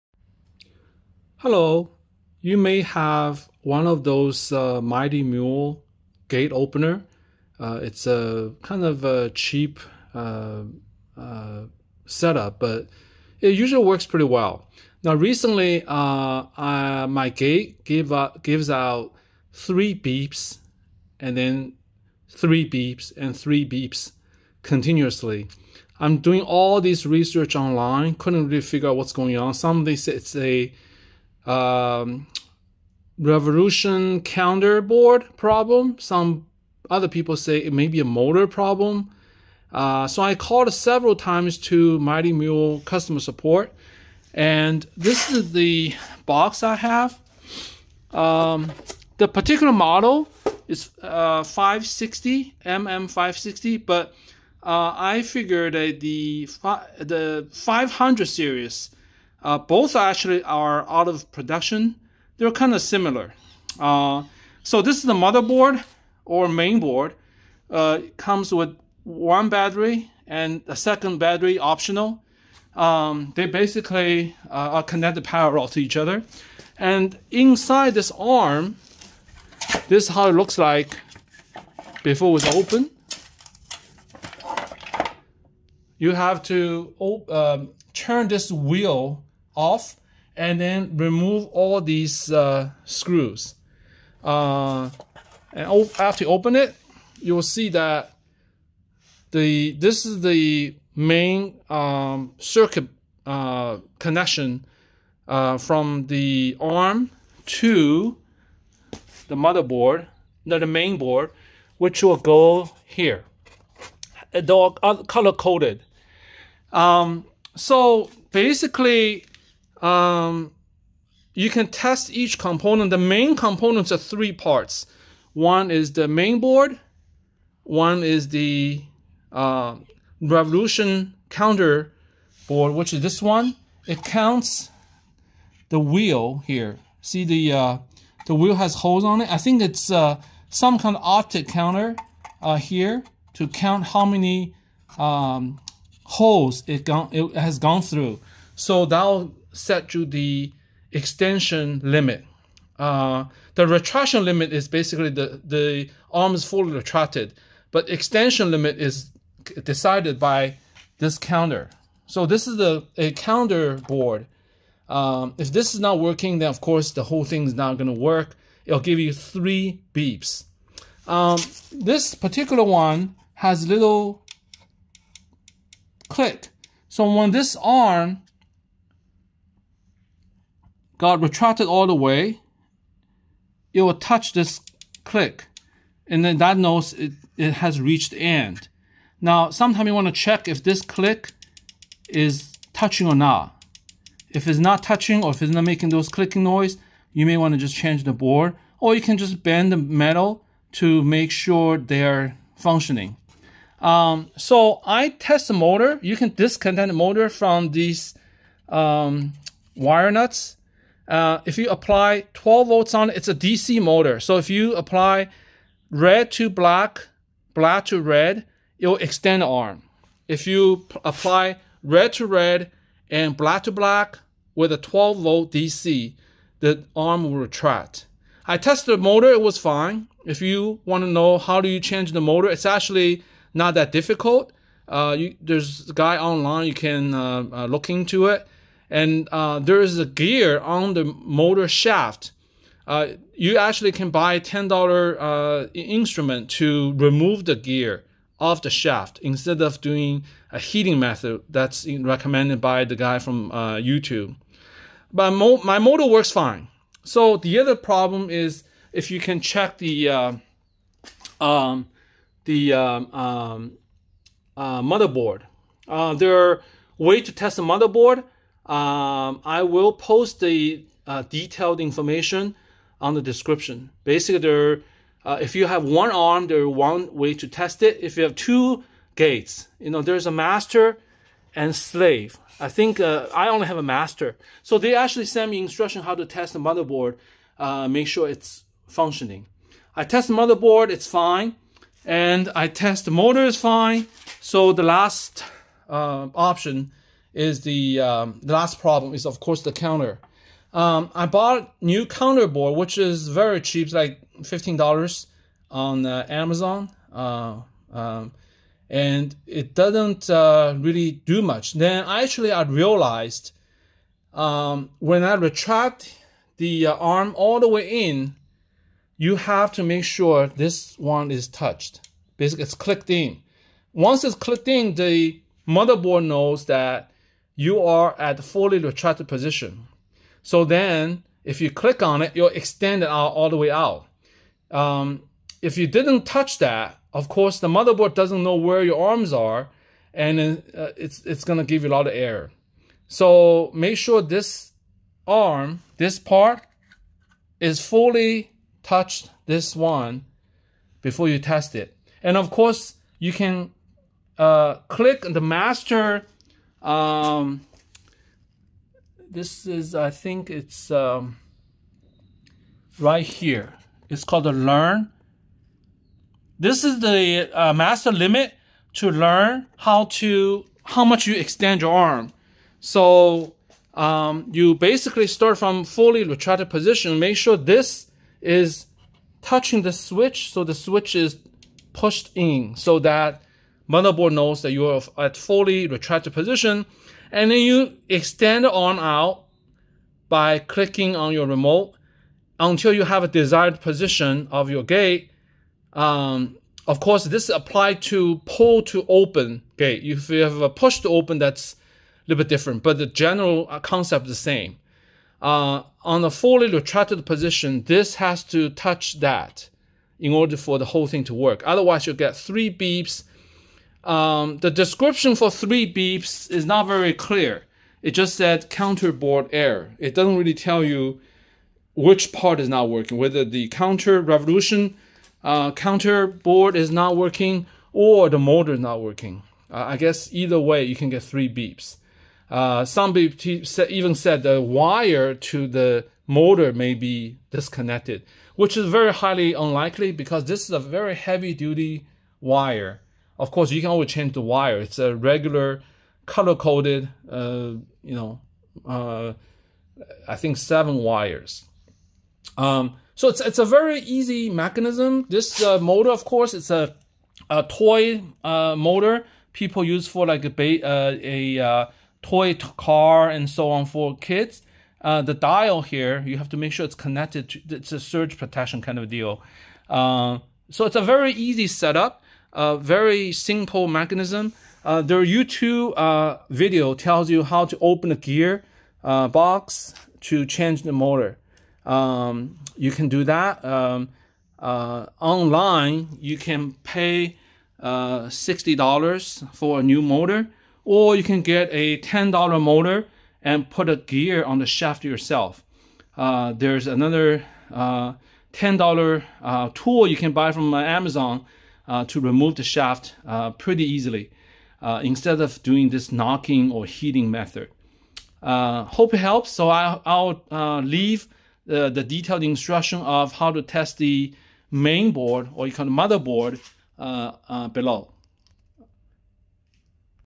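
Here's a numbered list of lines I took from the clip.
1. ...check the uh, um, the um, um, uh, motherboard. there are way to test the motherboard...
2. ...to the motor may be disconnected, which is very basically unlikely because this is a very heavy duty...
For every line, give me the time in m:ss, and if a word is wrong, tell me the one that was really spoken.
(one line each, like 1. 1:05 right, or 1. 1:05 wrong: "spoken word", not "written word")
1. 4:19 right
2. 7:15 wrong: "highly", not "basically".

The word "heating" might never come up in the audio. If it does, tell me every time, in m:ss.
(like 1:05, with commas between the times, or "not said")
4:10, 8:26.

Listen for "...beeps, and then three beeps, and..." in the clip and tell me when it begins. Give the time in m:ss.
0:19.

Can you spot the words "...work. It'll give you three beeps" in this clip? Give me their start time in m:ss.
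2:47.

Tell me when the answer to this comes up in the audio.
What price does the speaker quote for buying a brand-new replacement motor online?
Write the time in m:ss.
8:08.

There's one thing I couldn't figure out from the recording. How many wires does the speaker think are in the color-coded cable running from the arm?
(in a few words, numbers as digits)
7.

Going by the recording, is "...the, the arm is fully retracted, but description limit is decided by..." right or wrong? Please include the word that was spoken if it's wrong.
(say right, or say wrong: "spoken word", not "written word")
wrong: "extension", not "description".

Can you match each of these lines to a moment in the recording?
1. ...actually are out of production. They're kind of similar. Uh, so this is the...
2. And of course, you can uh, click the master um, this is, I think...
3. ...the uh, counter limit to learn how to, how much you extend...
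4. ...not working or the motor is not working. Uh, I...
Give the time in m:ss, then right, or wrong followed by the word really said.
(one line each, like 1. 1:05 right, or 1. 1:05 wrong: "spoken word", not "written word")
1. 0:59 right
2. 5:52 right
3. 6:06 wrong: "master", not "counter"
4. 7:06 right.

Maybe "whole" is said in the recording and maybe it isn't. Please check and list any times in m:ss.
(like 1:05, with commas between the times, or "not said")
2:47, 6:50.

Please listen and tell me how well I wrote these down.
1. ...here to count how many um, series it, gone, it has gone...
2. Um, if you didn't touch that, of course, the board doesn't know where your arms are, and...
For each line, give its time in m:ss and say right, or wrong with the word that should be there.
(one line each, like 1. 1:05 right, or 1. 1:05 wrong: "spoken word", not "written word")
1. 2:22 wrong: "holes", not "series"
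2. 5:34 wrong: "motherboard", not "board".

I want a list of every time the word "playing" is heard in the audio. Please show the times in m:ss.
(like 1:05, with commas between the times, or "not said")
not said.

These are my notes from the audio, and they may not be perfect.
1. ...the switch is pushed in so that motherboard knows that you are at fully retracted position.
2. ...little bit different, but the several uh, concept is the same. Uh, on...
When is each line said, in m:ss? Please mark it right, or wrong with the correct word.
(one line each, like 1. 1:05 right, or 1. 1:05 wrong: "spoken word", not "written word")
1. 6:20 right
2. 6:42 wrong: "general", not "several".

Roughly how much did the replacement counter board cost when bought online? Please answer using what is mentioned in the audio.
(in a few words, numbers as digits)
$15.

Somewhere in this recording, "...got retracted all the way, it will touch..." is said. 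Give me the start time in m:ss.
3:01.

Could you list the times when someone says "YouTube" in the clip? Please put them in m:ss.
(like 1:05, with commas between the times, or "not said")
4:13, 7:55.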